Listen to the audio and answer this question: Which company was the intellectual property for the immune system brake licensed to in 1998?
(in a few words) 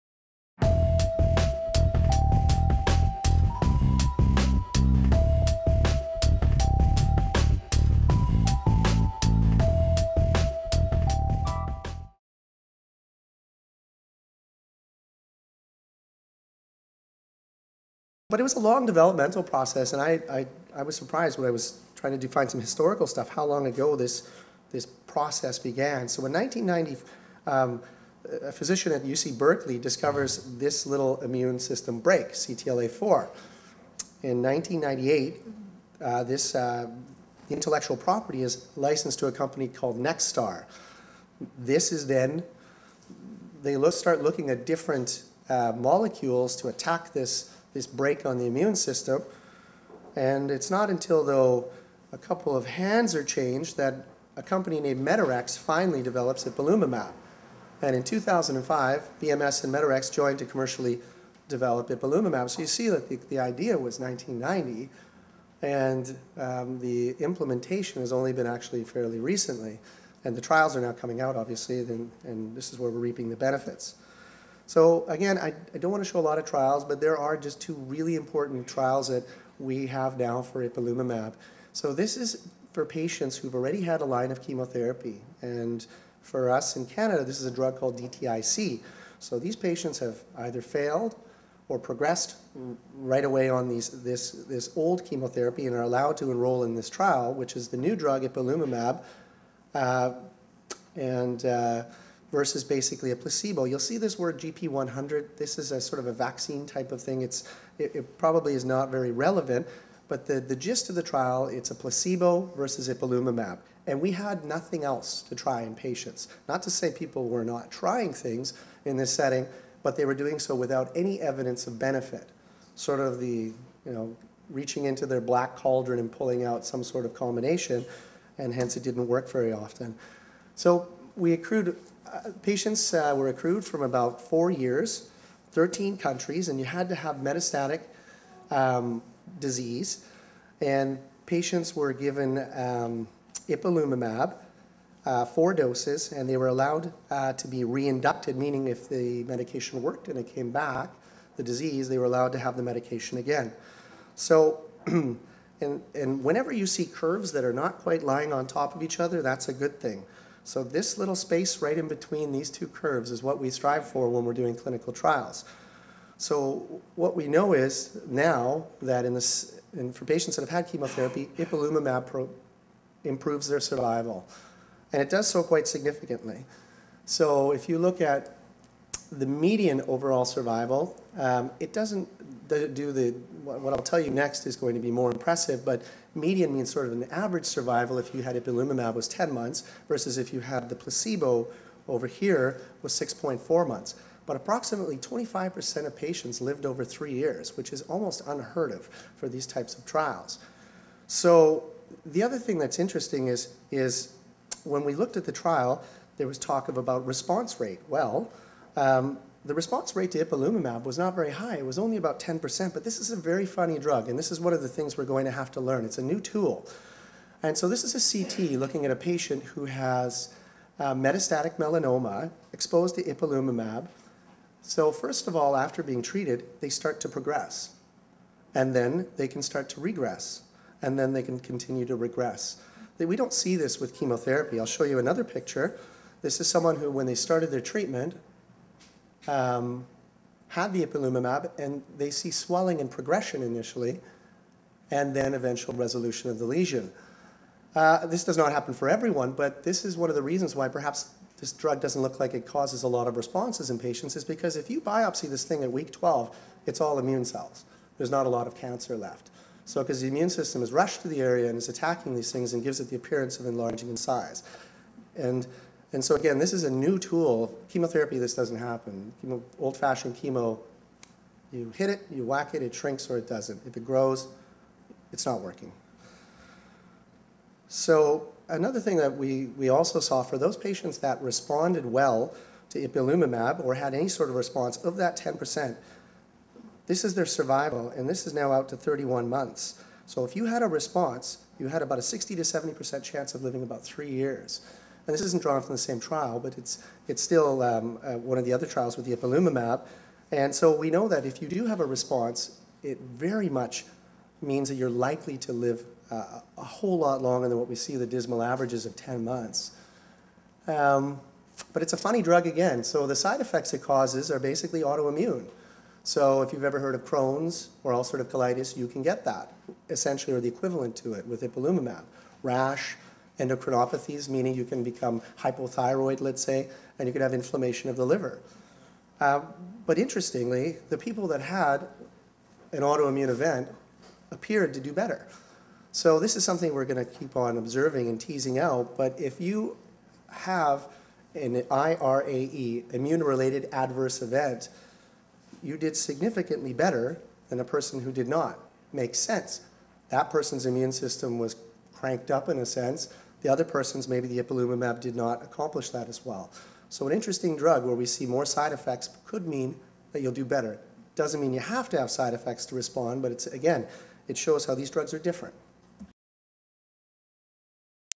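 NeXstar.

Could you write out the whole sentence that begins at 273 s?
If it grows, it's not working.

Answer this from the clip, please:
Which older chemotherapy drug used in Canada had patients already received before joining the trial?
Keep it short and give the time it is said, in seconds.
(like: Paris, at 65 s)
DTIC, at 87 s.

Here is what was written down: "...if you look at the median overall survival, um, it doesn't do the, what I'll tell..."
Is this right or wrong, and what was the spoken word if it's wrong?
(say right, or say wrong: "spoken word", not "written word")
right.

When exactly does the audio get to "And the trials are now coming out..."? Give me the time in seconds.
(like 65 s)
70 s.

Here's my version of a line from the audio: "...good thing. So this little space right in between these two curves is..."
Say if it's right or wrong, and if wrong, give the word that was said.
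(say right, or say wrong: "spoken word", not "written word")
right.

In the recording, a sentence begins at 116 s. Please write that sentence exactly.
Not to say people were not trying things in this setting, but they were doing so without any evidence of benefit.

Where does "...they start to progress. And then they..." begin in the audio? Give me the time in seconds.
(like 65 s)
226 s.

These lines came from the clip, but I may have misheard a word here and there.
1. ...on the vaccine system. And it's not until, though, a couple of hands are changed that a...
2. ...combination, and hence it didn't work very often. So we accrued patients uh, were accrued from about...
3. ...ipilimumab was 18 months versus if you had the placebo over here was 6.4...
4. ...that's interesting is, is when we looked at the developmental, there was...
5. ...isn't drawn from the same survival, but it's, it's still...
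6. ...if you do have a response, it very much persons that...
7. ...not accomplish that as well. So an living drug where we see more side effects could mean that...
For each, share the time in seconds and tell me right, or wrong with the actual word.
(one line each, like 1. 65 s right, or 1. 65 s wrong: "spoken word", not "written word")
1. 48 s wrong: "immune", not "vaccine"
2. 127 s right
3. 188 s wrong: "10", not "18"
4. 202 s wrong: "trial", not "developmental"
5. 295 s wrong: "trial", not "survival"
6. 301 s wrong: "means", not "persons"
7. 355 s wrong: "interesting", not "living".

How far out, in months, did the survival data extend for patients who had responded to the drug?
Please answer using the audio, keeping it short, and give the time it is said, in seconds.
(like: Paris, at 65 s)
31 months, at 288 s.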